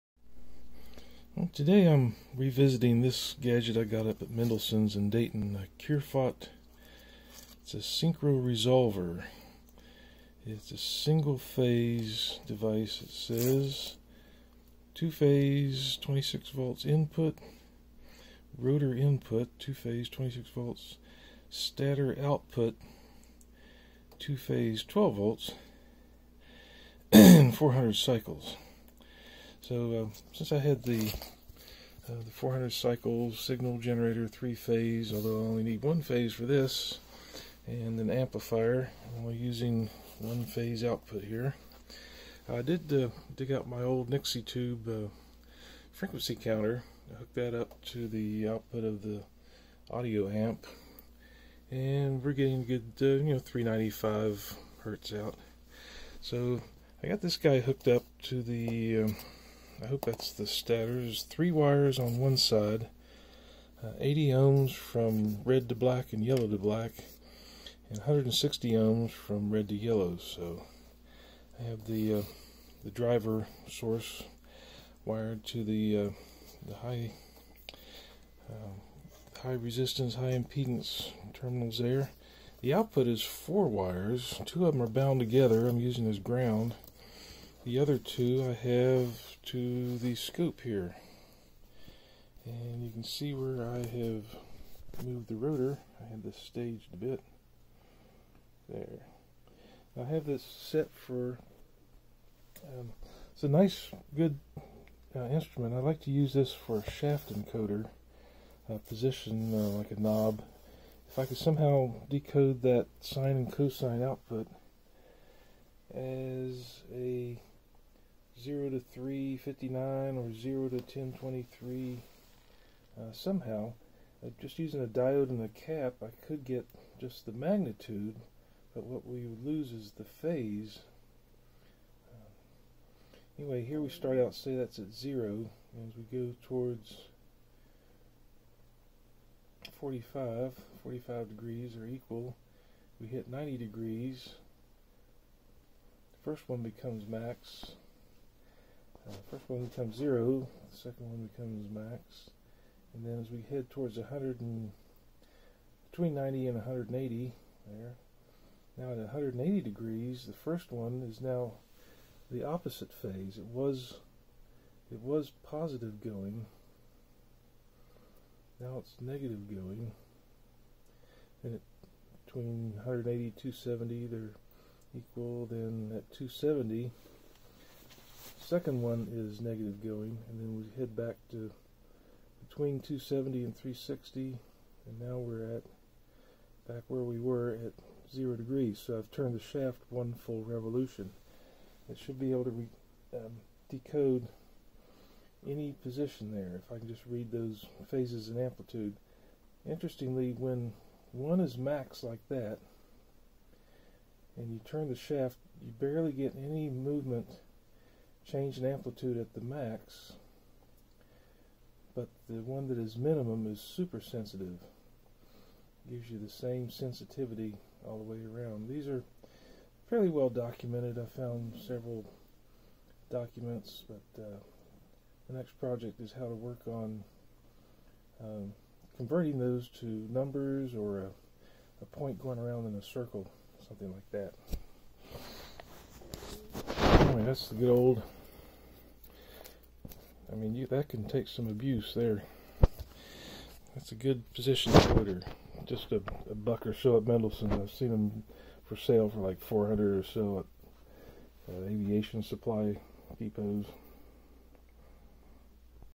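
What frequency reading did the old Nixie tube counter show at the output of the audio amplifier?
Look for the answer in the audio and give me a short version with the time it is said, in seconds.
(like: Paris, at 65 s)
395 hertz, at 53 s.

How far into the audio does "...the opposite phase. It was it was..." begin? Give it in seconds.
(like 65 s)
162 s.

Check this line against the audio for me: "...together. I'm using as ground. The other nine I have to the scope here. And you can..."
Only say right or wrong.
wrong.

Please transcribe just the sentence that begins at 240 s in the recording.
I mean, you, that can take some abuse there.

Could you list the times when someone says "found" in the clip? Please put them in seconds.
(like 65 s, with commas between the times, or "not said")
221 s.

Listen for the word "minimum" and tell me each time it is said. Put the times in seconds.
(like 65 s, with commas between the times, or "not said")
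212 s.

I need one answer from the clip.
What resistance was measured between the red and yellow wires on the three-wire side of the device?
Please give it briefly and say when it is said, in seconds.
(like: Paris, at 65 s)
160 ohms, at 67 s.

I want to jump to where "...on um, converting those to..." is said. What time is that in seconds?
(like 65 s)
226 s.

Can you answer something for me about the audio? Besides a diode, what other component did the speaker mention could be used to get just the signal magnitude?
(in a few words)
a cap.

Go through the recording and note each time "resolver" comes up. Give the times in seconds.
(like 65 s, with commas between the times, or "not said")
8 s.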